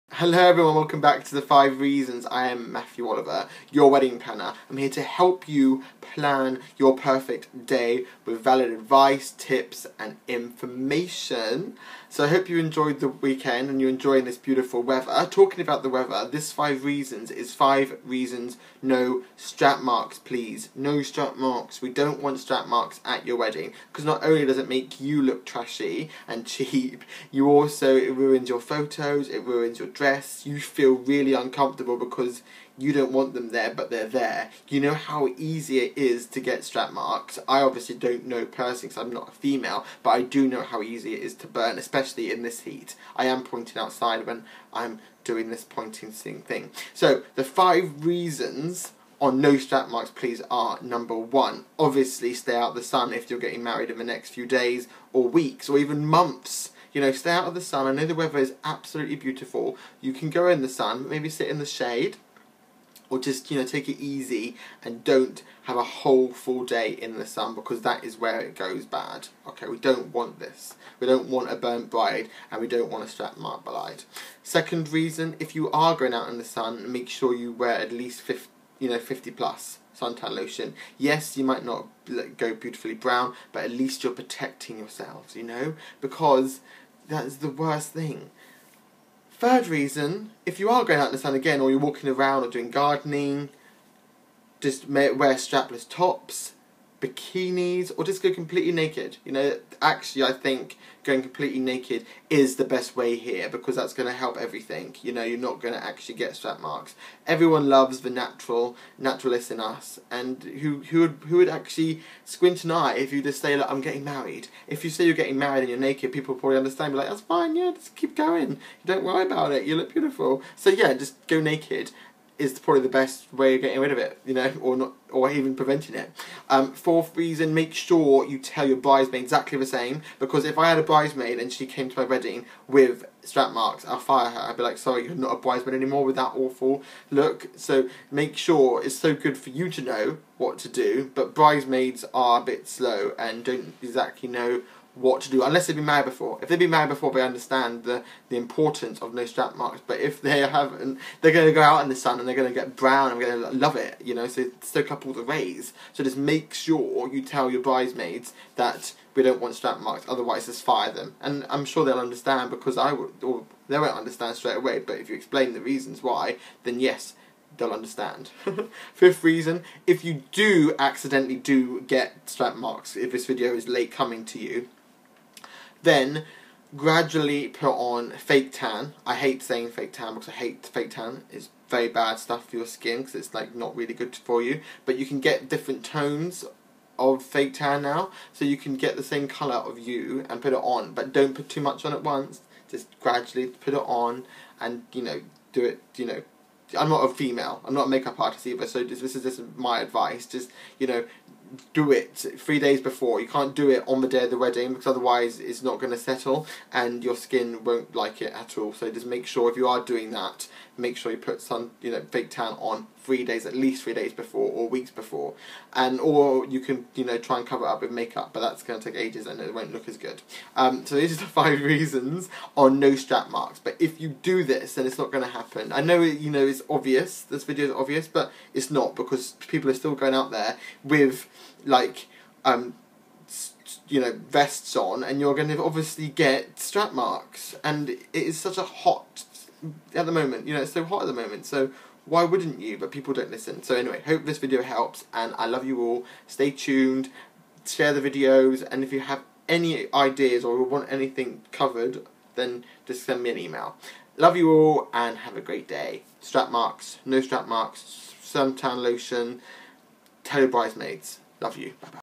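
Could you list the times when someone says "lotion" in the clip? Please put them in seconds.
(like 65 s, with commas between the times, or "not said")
80 s, 258 s.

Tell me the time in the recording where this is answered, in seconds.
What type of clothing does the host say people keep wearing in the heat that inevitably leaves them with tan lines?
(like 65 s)
234 s.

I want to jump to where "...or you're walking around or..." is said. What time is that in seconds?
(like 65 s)
91 s.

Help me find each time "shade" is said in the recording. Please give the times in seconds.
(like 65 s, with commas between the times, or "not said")
61 s.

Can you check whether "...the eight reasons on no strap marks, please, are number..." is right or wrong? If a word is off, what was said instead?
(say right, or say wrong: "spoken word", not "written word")
wrong: "five", not "eight".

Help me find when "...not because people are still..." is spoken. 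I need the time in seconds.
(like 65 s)
228 s.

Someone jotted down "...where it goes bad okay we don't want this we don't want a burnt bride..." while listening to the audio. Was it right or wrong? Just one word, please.
right.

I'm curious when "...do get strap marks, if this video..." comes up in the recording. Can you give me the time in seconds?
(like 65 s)
171 s.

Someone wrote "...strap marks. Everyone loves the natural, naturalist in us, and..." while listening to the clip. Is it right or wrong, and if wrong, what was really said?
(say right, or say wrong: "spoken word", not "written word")
right.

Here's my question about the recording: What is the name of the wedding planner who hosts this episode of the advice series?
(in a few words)
Matthew Oliver.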